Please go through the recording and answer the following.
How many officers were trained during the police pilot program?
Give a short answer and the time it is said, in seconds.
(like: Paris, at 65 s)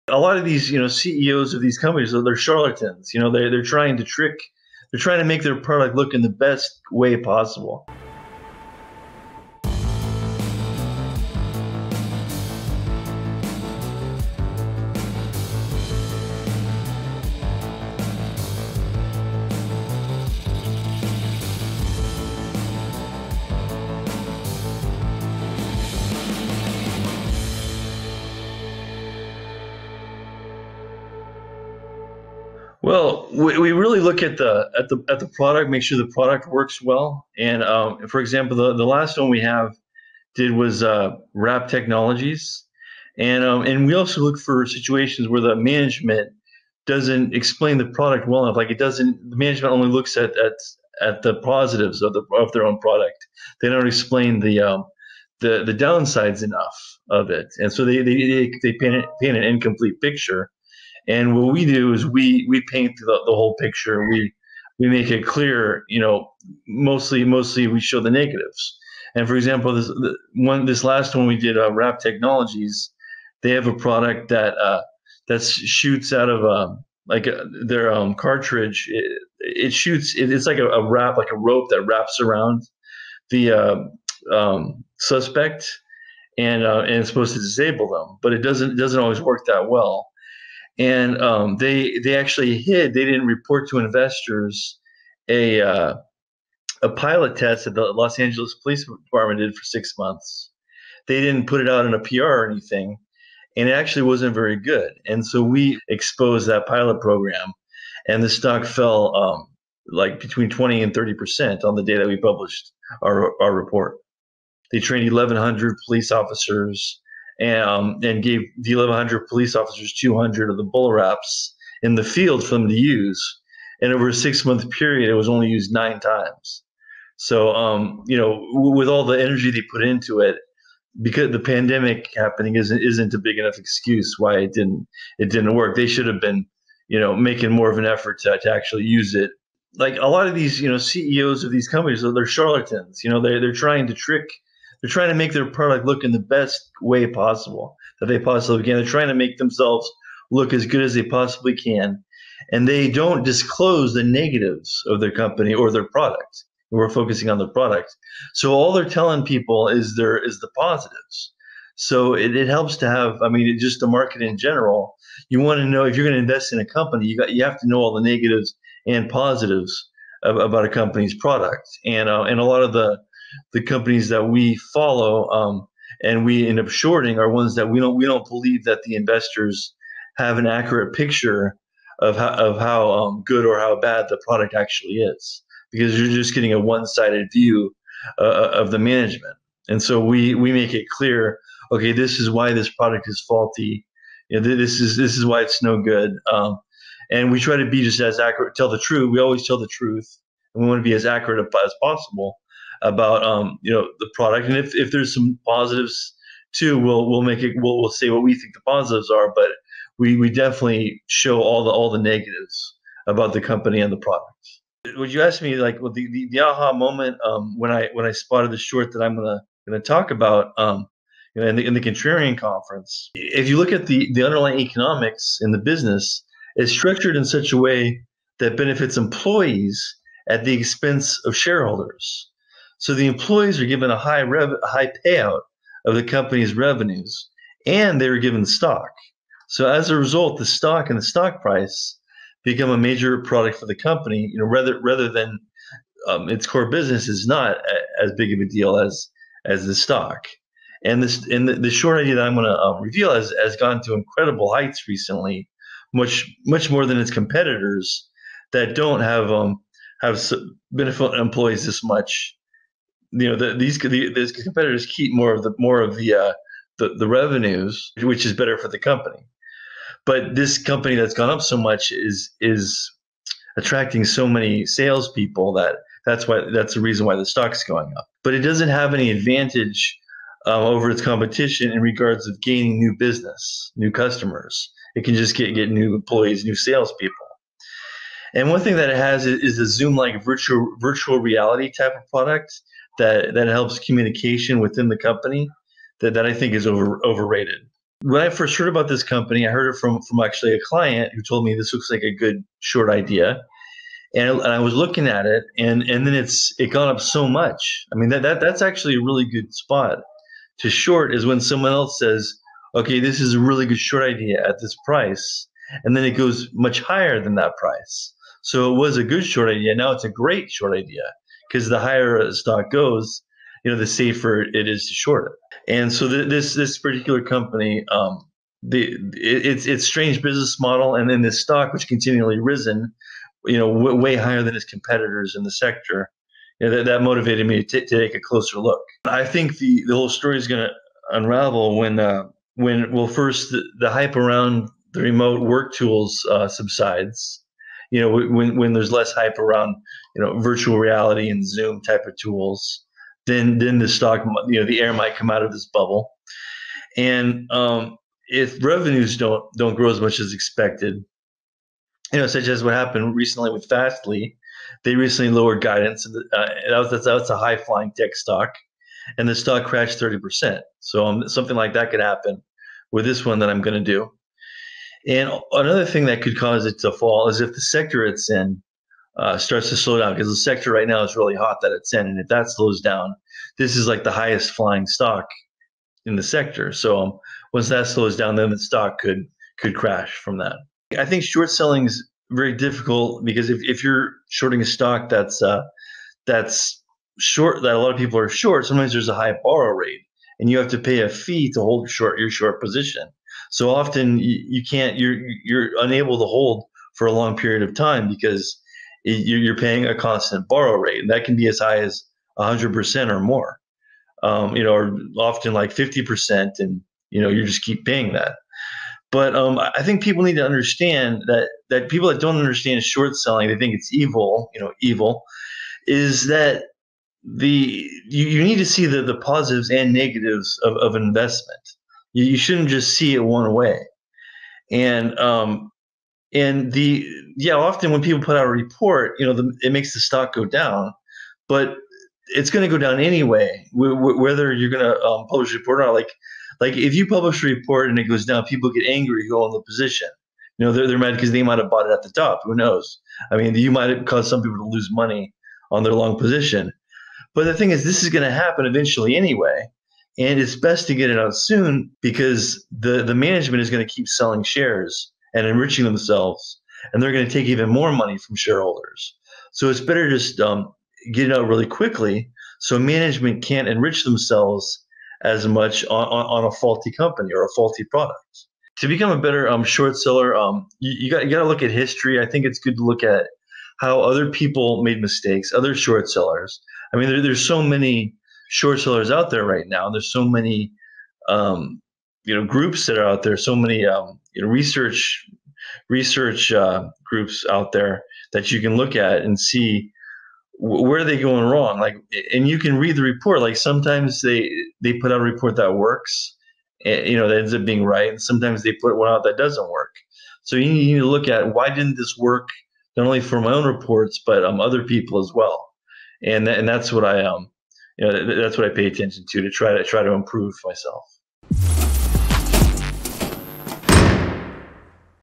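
1,100, at 115 s.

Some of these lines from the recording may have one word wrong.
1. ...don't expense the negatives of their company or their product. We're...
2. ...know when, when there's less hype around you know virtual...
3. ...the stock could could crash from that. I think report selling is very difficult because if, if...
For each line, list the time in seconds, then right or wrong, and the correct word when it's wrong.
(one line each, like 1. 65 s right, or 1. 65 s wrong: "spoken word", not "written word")
1. 152 s wrong: "disclose", not "expense"
2. 348 s right
3. 388 s wrong: "short", not "report".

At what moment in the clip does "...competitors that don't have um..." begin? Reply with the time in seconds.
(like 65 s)
257 s.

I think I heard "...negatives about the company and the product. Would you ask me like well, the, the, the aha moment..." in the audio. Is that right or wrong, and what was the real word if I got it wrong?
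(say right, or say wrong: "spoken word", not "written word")
right.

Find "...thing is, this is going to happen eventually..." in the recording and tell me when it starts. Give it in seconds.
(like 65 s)
457 s.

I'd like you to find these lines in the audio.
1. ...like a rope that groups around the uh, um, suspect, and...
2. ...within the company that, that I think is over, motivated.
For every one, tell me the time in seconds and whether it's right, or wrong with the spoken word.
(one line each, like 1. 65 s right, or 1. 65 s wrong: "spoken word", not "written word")
1. 81 s wrong: "wraps", not "groups"
2. 294 s wrong: "overrated", not "motivated".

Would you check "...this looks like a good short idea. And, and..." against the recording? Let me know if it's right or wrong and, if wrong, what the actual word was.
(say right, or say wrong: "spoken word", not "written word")
right.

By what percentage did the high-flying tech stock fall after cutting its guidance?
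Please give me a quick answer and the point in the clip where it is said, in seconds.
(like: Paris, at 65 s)
30%, at 369 s.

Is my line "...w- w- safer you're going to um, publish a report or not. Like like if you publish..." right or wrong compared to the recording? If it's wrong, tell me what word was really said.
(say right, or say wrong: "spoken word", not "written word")
wrong: "whether", not "safer".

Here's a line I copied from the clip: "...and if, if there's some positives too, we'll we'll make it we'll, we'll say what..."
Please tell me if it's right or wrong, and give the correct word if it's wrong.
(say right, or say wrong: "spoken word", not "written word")
right.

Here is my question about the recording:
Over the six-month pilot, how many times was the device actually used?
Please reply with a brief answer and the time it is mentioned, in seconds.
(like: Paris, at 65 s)
9, at 125 s.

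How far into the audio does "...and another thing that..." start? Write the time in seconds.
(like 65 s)
375 s.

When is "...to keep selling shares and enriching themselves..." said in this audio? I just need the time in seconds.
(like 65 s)
463 s.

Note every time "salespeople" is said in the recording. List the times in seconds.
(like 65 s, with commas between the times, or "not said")
274 s, 286 s.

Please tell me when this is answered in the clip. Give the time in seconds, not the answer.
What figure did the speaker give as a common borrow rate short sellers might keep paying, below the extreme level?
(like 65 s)
415 s.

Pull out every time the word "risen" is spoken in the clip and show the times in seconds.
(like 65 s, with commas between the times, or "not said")
332 s.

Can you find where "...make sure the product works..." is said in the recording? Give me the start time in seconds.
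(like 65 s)
35 s.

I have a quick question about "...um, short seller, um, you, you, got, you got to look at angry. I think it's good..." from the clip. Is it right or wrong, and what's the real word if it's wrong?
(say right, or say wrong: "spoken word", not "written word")
wrong: "history", not "angry".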